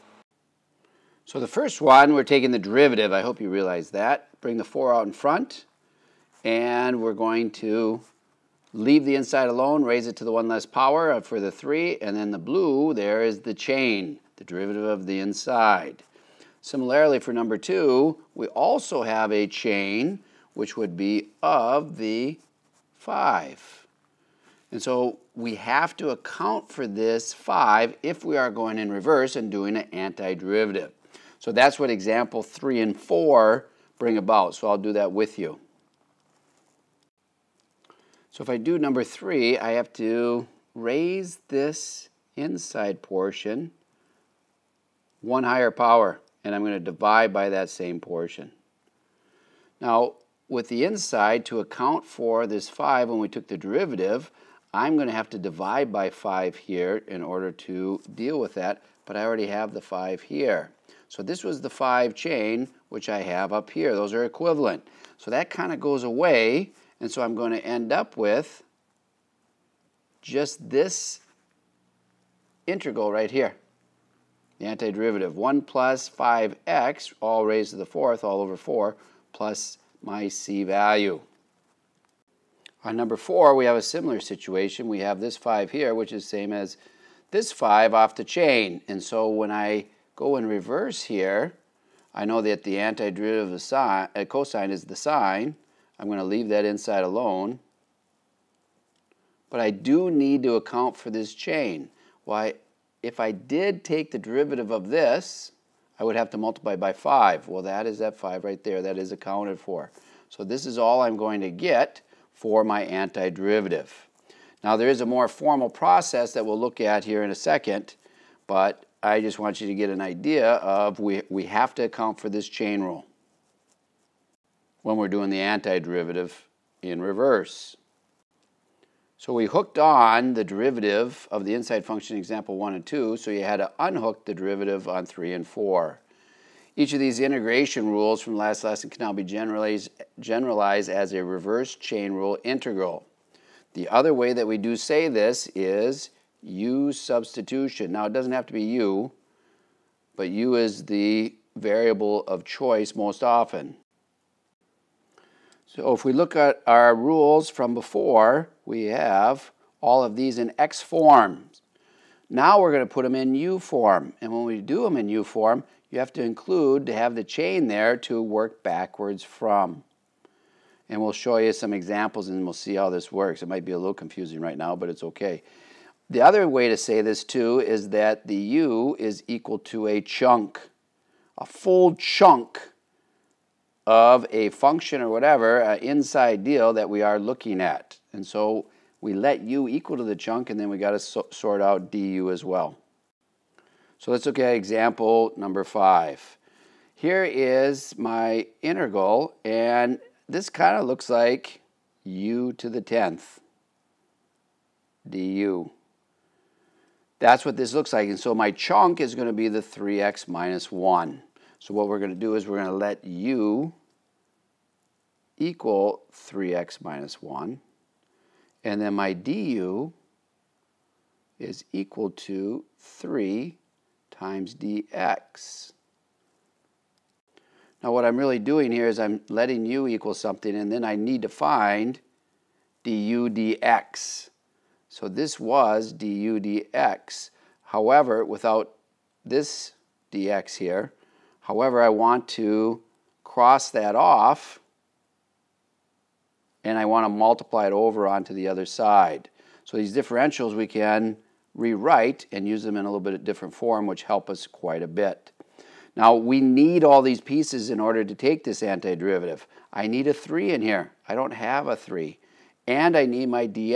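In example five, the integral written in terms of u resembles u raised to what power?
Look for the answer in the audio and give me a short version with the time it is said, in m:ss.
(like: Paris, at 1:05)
10th, at 3:22.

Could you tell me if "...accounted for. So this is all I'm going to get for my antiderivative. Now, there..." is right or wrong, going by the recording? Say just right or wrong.
right.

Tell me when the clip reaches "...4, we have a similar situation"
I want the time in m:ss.
1:23.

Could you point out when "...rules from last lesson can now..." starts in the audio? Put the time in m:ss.
2:17.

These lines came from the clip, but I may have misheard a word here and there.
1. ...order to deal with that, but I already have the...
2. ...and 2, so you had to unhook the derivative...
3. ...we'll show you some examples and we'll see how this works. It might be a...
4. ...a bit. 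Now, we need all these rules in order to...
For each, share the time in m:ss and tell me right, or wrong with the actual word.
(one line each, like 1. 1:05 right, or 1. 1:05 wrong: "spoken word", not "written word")
1. 0:57 right
2. 2:12 right
3. 2:51 right
4. 4:14 wrong: "pieces", not "rules".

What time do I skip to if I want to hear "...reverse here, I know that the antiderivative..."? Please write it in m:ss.
1:30.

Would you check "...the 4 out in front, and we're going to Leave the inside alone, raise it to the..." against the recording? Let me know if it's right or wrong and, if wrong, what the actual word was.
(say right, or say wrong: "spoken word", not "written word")
right.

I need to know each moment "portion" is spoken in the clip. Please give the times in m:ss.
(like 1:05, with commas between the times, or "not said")
0:43, 0:47.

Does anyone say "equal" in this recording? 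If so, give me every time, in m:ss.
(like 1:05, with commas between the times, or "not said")
2:59, 3:09, 3:35, 3:41, 3:49.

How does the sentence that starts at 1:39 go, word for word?
But I do need to account for this chain.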